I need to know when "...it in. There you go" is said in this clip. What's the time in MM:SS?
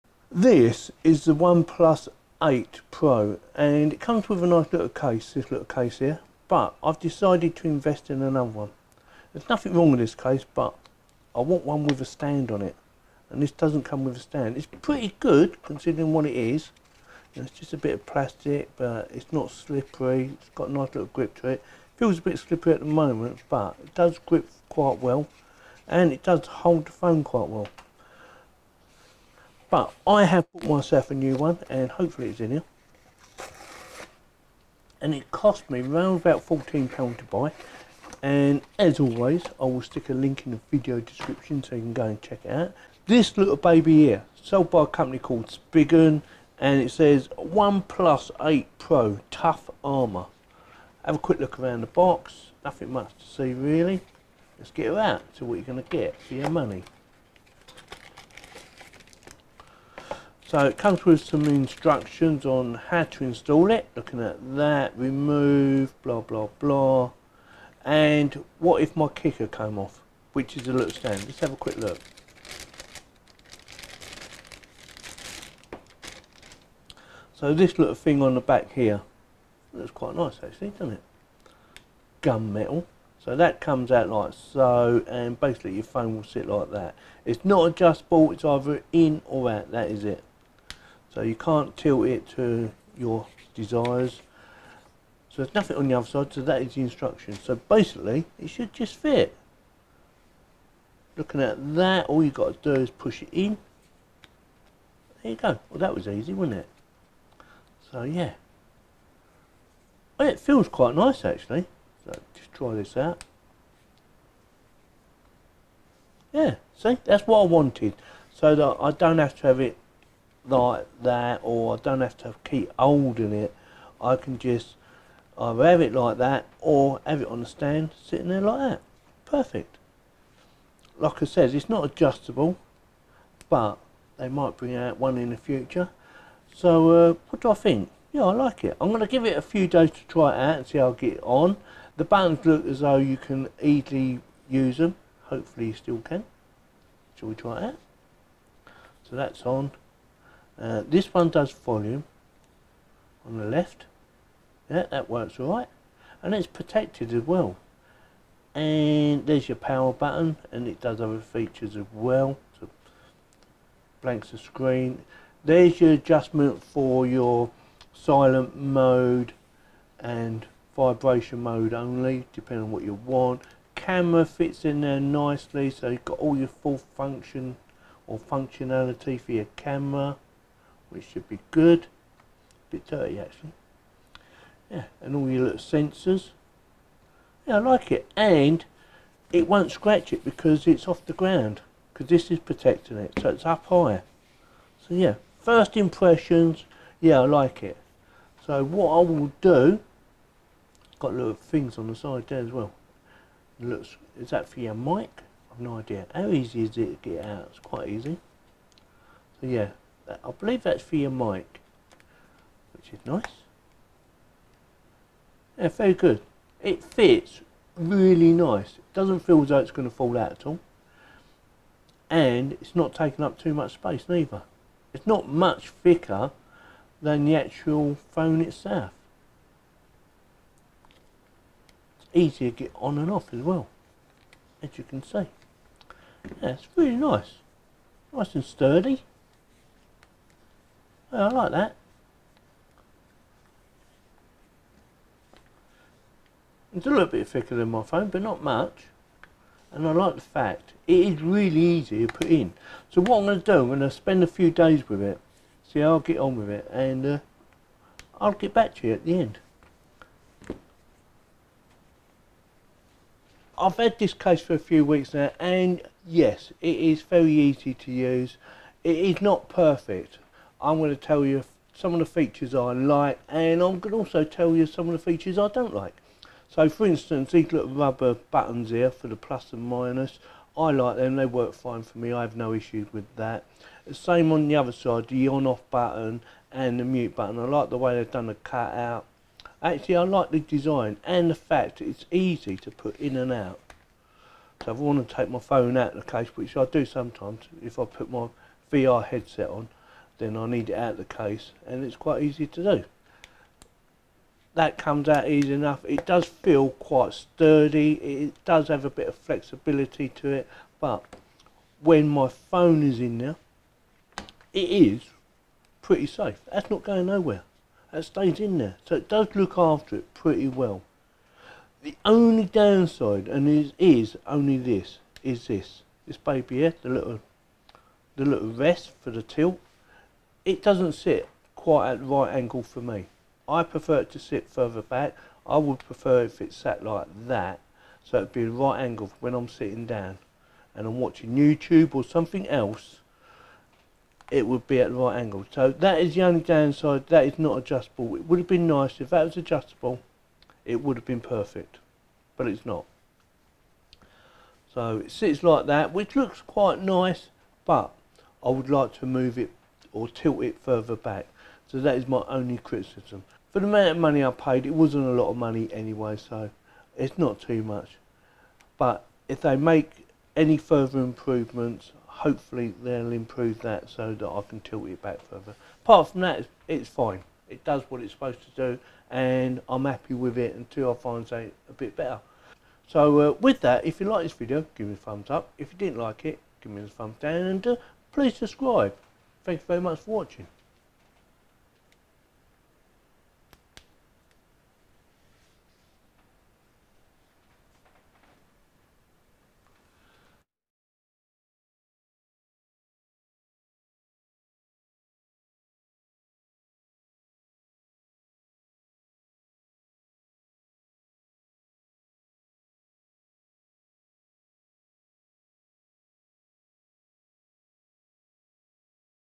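01:43.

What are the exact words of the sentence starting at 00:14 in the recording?
It's pretty good considering what it is.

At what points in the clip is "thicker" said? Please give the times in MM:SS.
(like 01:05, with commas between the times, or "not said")
03:45, 04:07.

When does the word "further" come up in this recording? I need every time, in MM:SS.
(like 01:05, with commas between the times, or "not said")
05:34, 06:00, 06:10, 06:15.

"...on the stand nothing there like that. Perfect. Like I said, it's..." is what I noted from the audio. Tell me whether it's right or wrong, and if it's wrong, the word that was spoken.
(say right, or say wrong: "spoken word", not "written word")
wrong: "sitting", not "nothing".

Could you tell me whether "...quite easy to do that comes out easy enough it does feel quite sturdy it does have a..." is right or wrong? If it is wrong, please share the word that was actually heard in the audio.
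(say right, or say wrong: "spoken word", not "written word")
right.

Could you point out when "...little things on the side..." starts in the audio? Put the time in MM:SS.
03:21.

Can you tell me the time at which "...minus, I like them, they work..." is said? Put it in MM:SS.
04:39.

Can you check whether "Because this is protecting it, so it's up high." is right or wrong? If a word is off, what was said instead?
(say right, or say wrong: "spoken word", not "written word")
right.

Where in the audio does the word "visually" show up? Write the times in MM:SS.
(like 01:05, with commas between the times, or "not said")
not said.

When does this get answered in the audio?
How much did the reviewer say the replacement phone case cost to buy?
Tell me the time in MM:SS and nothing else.
00:36.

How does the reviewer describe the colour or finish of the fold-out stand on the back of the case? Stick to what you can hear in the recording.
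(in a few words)
Gun metal.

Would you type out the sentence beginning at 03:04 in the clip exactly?
Yeah, and all your little sensors.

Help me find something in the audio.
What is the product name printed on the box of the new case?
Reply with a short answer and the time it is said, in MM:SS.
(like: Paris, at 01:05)
Tough Armour, at 00:49.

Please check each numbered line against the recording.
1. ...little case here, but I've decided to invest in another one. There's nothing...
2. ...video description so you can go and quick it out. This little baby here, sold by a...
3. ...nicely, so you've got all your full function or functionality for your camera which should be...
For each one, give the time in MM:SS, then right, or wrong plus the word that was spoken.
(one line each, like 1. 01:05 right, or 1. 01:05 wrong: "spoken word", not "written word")
1. 00:05 right
2. 00:40 wrong: "check", not "quick"
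3. 02:54 right.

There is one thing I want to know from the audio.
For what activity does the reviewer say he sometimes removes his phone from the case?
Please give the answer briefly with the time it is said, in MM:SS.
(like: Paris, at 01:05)
VR headset, at 04:58.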